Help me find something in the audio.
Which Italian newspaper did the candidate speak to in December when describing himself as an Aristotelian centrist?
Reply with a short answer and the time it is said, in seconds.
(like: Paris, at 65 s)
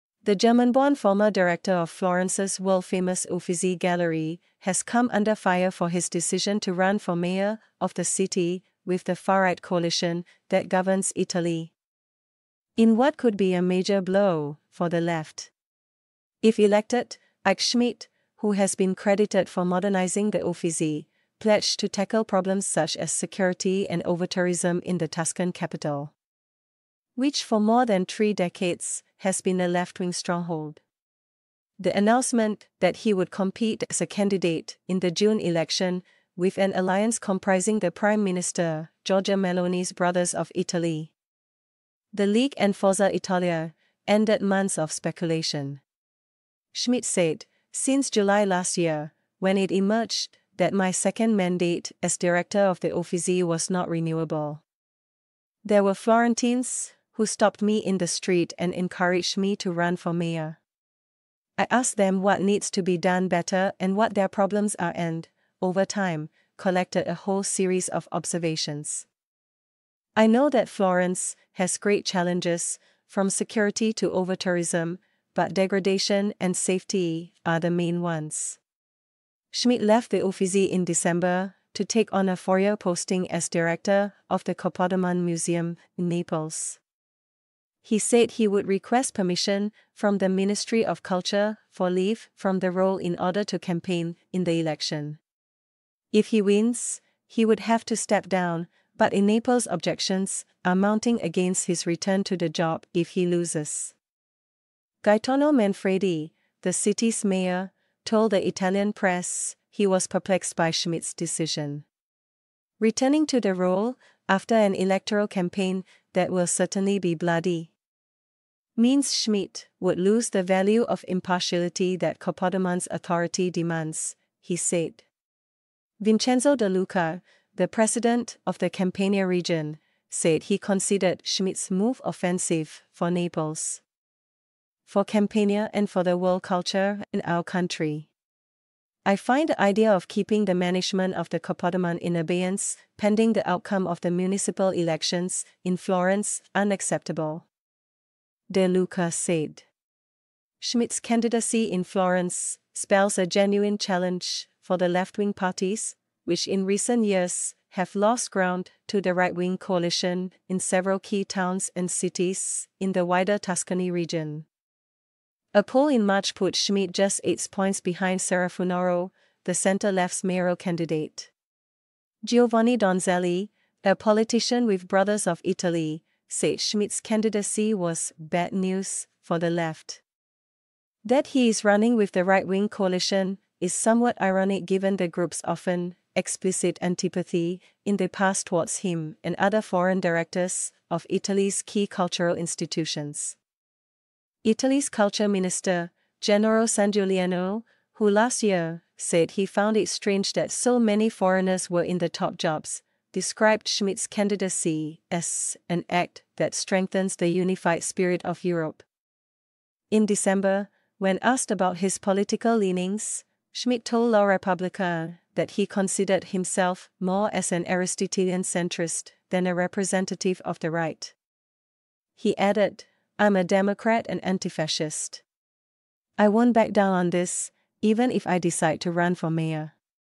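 La Repubblica, at 214 s.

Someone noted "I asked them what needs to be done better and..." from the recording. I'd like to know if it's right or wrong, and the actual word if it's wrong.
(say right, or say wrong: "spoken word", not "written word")
right.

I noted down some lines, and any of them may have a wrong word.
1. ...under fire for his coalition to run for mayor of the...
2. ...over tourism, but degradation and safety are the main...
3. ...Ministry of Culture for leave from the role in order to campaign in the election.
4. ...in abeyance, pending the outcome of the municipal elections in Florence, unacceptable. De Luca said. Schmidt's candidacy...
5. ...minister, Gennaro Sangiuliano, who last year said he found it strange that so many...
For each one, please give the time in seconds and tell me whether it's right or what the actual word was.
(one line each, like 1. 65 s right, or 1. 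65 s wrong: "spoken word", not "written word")
1. 5 s wrong: "decision", not "coalition"
2. 74 s right
3. 90 s right
4. 142 s right
5. 195 s right.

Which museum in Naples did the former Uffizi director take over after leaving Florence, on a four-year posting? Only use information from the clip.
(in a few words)
Capodimonte Museum.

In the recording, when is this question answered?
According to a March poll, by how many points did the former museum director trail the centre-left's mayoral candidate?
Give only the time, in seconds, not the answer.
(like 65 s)
167 s.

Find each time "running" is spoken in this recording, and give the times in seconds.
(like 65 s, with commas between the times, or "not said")
181 s.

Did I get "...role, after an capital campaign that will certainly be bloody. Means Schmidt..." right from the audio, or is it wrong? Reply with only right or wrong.
wrong.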